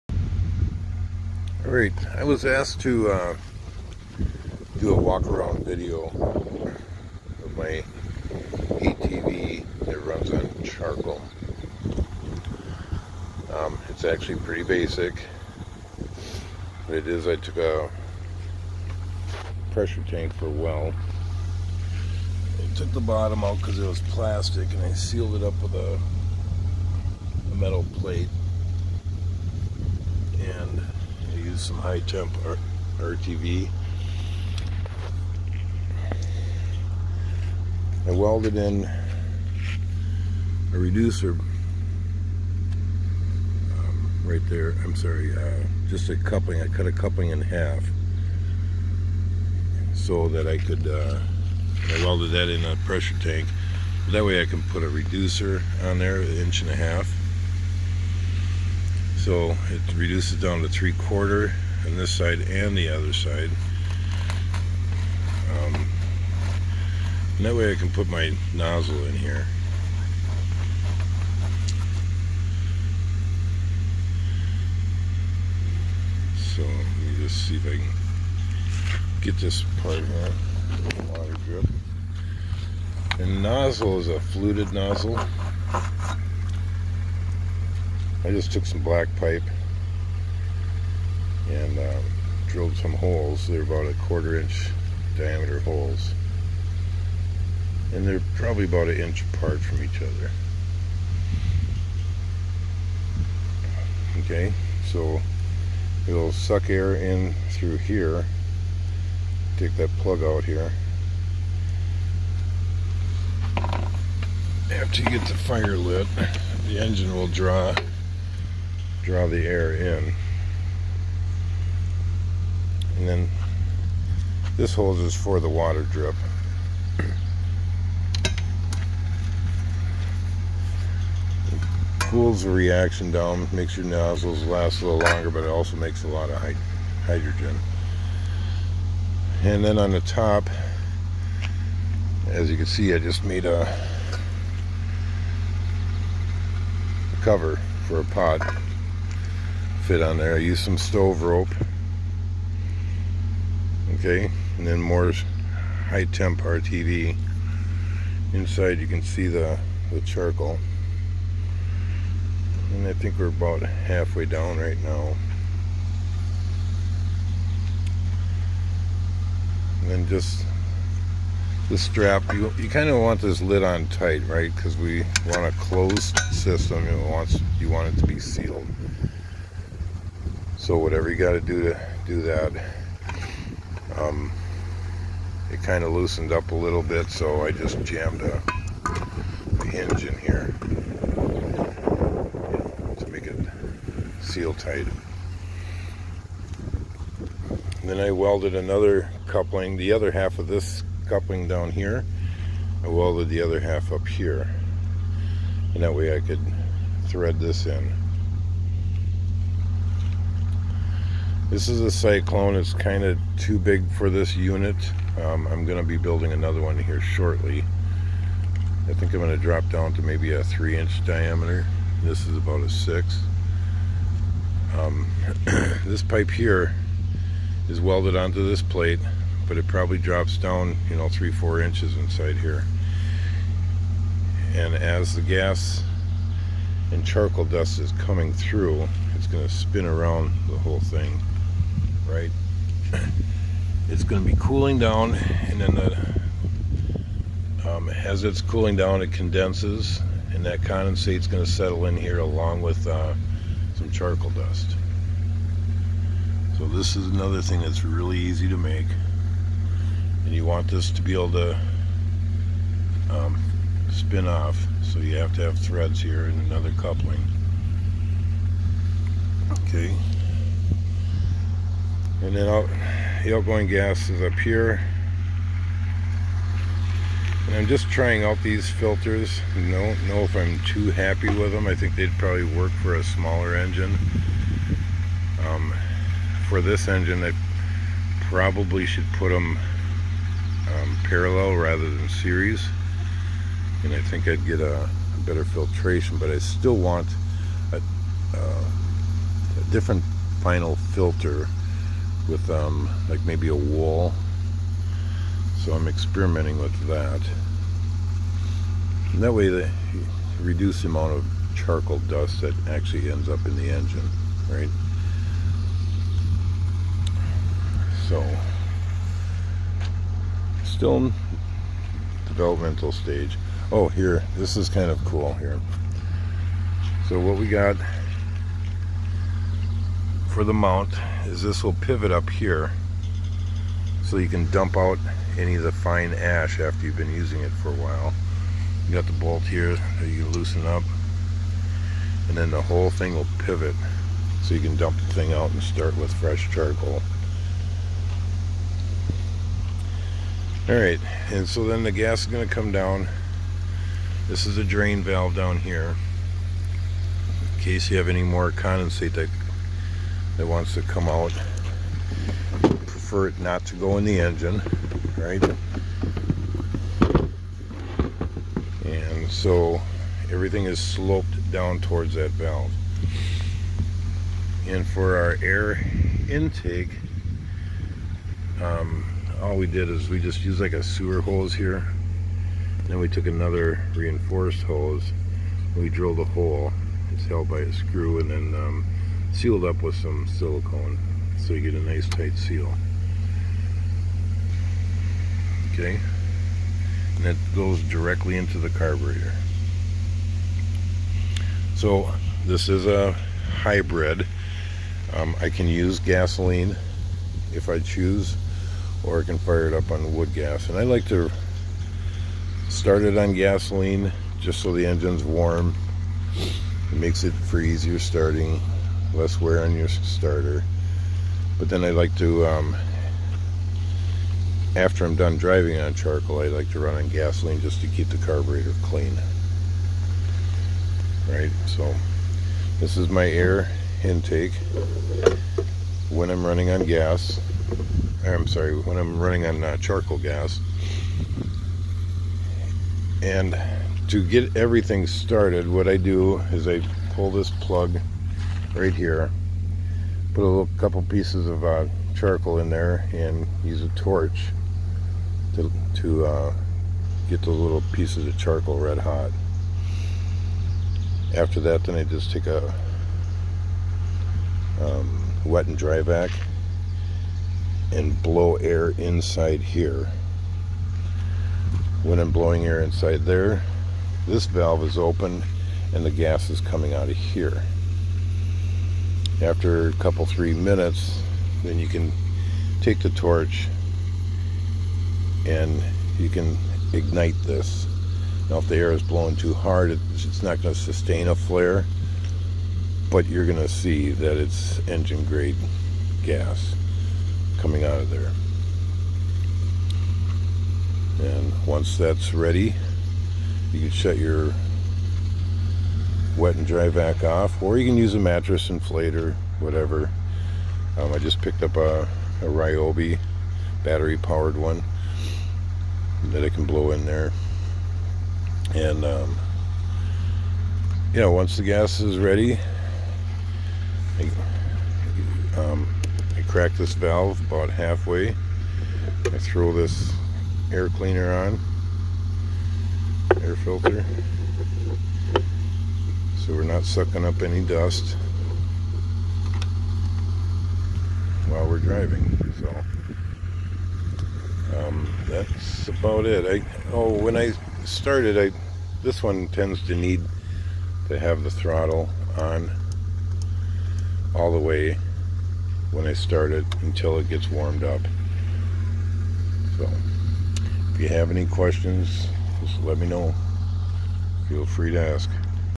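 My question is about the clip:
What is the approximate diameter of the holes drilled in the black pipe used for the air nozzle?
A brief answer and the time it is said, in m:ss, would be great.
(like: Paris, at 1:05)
1/4 inch, at 1:34.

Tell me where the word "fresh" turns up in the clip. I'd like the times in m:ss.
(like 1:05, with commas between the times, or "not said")
5:46.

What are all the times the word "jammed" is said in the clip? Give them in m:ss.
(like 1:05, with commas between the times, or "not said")
3:07.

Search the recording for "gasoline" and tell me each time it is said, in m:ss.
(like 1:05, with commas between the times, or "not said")
6:45, 6:53, 7:07.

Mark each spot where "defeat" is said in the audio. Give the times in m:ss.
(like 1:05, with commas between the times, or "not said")
not said.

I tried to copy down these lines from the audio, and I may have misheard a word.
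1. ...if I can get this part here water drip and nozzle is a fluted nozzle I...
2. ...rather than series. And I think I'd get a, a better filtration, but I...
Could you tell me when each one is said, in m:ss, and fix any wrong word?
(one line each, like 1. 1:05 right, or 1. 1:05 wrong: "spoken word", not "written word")
1. 1:17 right
2. 4:51 right.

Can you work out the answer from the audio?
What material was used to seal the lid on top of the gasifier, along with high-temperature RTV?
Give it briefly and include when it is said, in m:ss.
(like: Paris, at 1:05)
Stove rope, at 2:30.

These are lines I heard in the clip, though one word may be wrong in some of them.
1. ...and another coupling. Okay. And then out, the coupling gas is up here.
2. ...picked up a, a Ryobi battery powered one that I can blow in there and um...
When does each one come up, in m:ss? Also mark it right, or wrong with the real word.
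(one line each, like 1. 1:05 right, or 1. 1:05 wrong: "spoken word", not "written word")
1. 4:26 wrong: "outgoing", not "coupling"
2. 8:31 right.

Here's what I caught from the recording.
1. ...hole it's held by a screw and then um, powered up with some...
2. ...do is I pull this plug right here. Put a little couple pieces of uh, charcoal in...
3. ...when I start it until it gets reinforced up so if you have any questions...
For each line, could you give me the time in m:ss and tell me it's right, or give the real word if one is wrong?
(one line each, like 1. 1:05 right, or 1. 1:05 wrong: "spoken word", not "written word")
1. 6:26 wrong: "sealed", not "powered"
2. 7:25 right
3. 9:15 wrong: "warmed", not "reinforced".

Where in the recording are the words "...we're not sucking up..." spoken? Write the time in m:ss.
8:56.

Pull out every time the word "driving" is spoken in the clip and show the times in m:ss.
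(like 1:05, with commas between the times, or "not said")
7:05, 9:01.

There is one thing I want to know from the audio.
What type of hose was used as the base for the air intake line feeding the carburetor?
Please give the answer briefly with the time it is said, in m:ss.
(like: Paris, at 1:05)
Sewer hose, at 6:20.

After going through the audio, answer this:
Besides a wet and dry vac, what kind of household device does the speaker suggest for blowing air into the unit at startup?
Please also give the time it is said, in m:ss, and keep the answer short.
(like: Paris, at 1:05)
Mattress inflator, at 8:28.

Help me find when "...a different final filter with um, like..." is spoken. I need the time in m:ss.
4:59.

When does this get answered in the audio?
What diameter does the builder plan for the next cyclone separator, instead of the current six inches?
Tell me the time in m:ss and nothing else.
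3:40.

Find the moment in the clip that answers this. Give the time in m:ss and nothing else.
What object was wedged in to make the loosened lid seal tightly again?
3:09.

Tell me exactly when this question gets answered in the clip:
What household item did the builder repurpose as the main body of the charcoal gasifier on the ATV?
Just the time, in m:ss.
0:19.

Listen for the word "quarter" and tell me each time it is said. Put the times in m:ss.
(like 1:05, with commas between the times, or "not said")
1:00, 1:34.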